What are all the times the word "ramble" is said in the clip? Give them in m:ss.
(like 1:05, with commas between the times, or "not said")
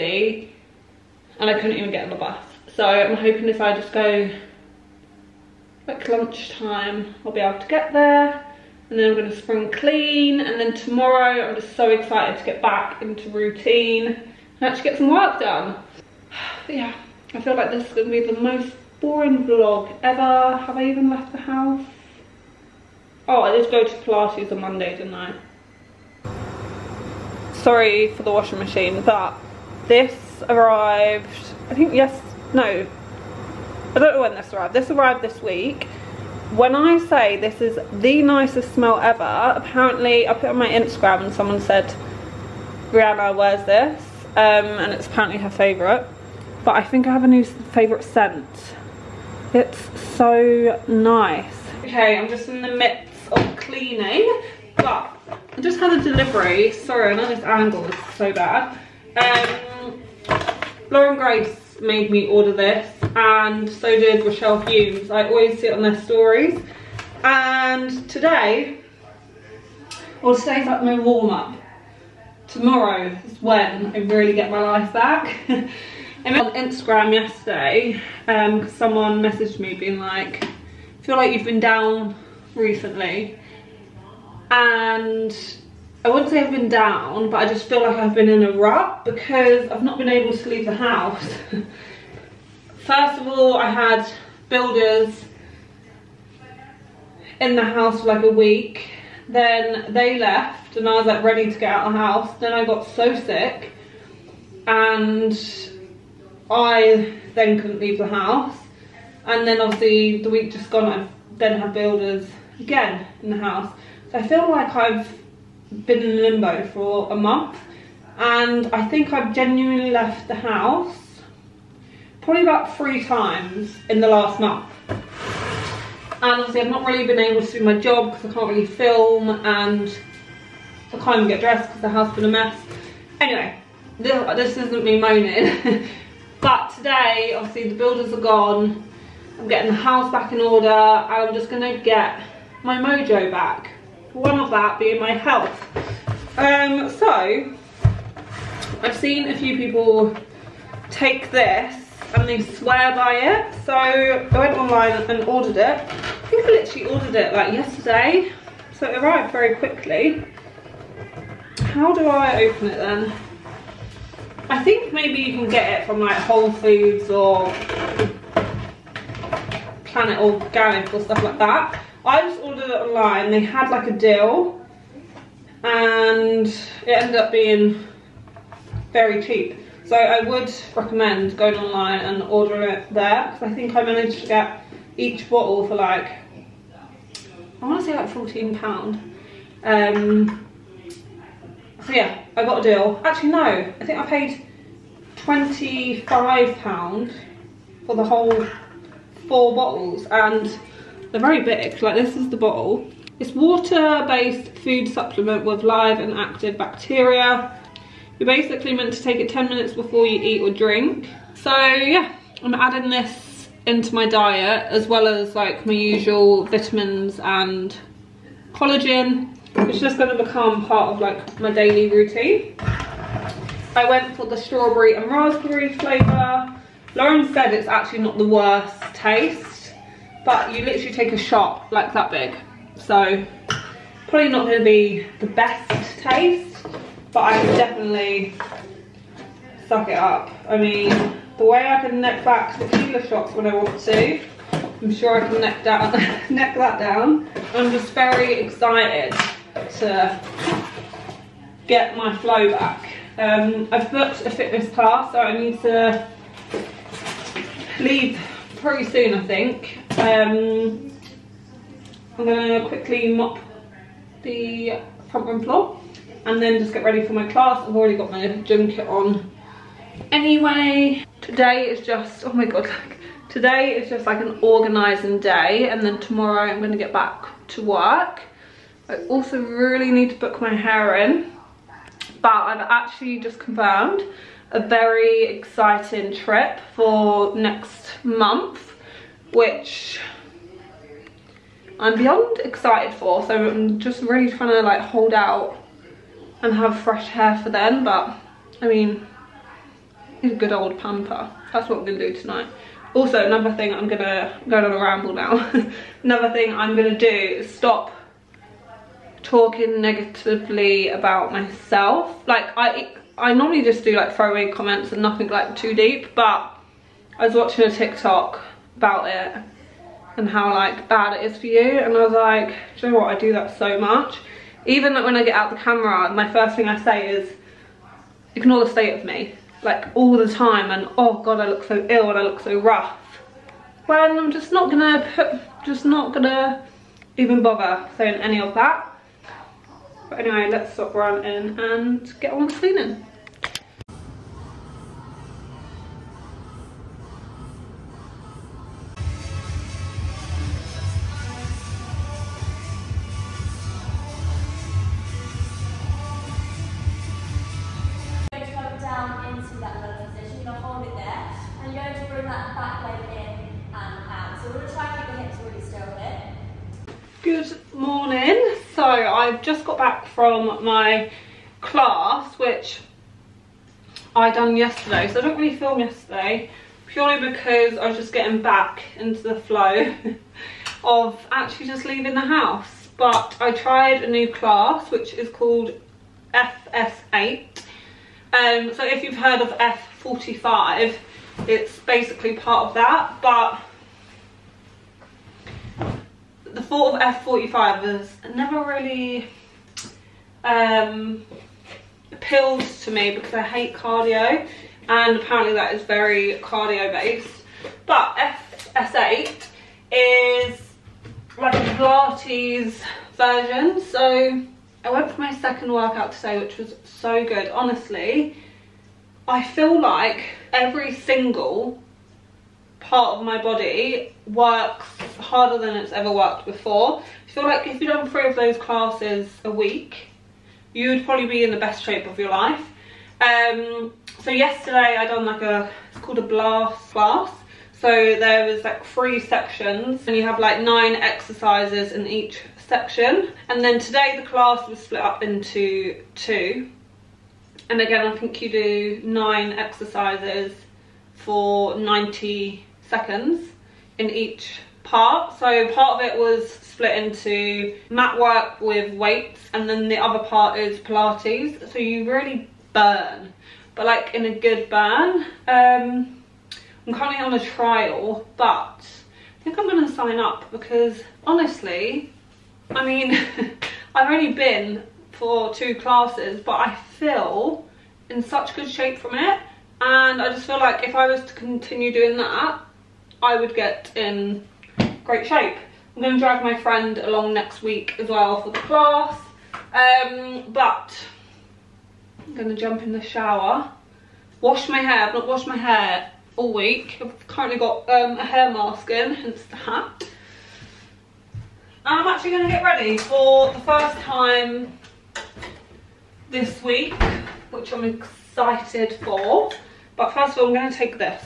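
5:04.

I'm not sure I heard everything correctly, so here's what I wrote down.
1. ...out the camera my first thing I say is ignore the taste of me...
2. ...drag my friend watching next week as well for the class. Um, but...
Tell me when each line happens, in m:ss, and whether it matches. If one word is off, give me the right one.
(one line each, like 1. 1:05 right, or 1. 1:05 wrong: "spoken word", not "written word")
1. 5:25 wrong: "state", not "taste"
2. 8:06 wrong: "along", not "watching".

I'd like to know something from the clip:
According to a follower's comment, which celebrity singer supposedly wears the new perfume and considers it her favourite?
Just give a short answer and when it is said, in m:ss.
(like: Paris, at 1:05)
Rihanna, at 0:42.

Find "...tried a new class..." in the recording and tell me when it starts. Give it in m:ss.
6:23.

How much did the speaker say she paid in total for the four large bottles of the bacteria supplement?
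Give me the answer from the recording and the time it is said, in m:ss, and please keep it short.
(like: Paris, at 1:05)
£25, at 3:15.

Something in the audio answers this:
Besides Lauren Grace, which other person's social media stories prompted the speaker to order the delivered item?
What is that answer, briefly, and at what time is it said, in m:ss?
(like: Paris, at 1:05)
Rochelle Humes, at 1:04.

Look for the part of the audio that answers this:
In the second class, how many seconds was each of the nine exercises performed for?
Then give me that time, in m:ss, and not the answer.
7:31.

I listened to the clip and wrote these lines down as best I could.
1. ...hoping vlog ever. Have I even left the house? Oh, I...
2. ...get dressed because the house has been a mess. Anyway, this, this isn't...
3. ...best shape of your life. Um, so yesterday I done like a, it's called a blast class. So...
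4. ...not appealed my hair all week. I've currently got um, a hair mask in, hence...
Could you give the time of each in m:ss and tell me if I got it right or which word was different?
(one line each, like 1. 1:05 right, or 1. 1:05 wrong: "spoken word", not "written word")
1. 0:18 wrong: "boring", not "hoping"
2. 2:11 right
3. 7:11 right
4. 8:15 wrong: "washed", not "appealed".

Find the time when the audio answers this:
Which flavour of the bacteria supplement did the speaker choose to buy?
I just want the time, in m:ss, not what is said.
3:44.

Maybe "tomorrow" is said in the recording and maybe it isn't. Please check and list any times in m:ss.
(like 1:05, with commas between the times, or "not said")
0:10, 1:12, 4:35.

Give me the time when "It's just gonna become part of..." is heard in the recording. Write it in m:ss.
3:39.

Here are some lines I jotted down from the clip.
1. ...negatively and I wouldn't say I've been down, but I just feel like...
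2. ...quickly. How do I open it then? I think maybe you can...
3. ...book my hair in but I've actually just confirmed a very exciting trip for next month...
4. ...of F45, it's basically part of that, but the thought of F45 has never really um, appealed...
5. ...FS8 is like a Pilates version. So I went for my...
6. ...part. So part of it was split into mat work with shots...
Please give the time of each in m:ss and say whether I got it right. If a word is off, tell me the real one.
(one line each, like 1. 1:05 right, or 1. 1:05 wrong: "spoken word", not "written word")
1. 1:22 wrong: "recently", not "negatively"
2. 2:39 right
3. 4:40 right
4. 6:29 right
5. 6:48 right
6. 7:34 wrong: "weights", not "shots".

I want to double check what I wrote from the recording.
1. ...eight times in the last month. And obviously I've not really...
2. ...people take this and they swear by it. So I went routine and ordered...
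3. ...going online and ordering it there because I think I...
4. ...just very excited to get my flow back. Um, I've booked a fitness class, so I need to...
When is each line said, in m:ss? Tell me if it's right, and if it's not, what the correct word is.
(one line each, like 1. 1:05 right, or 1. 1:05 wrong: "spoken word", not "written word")
1. 2:02 wrong: "three", not "eight"
2. 2:29 wrong: "online", not "routine"
3. 3:01 right
4. 4:07 right.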